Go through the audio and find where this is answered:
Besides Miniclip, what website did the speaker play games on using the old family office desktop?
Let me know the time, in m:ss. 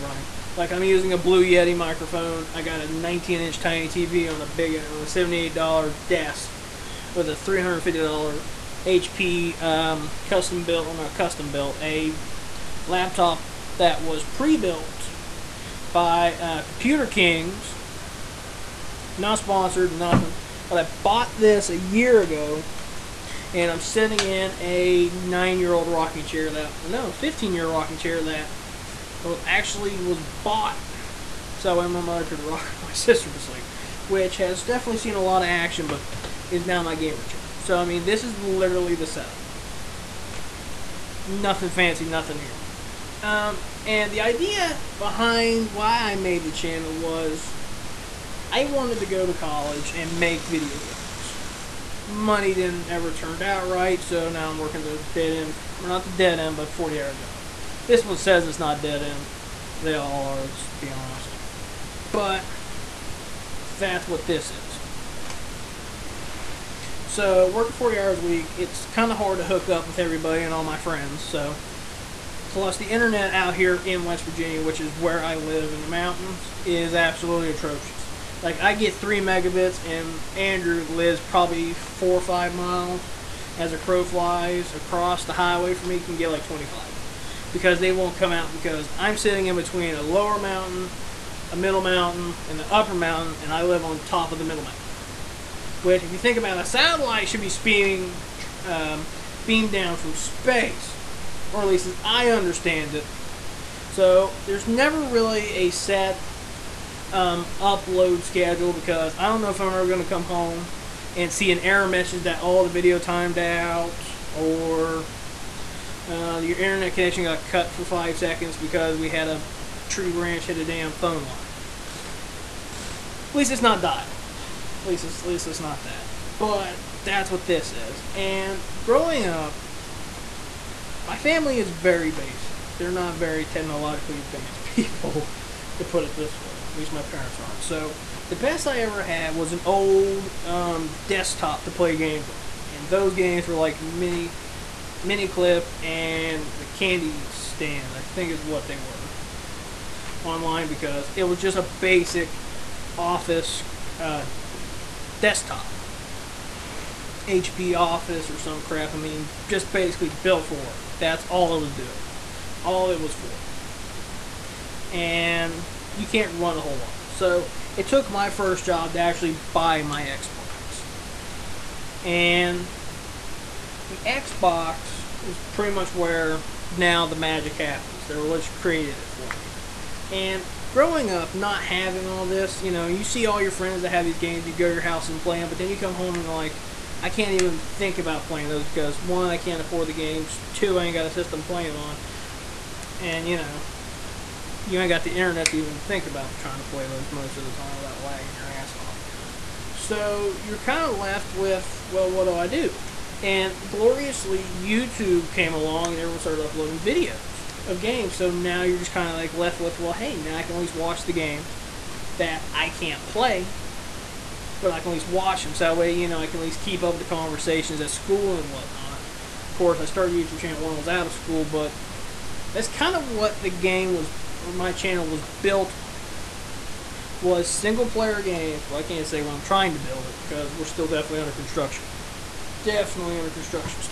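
2:26.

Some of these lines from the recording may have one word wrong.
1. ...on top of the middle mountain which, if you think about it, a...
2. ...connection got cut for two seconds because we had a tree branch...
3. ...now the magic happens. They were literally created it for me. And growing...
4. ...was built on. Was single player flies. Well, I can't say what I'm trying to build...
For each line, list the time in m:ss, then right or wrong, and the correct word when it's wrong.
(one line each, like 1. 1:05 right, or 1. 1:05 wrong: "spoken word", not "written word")
1. 1:33 right
2. 1:56 wrong: "five", not "two"
3. 2:56 right
4. 3:45 wrong: "games", not "flies".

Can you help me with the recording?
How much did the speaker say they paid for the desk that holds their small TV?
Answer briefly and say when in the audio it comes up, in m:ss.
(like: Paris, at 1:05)
$78, at 0:05.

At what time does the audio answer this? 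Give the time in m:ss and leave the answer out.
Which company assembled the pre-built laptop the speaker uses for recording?
0:16.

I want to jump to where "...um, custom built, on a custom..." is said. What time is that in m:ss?
0:09.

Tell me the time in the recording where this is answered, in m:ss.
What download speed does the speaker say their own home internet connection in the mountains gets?
1:18.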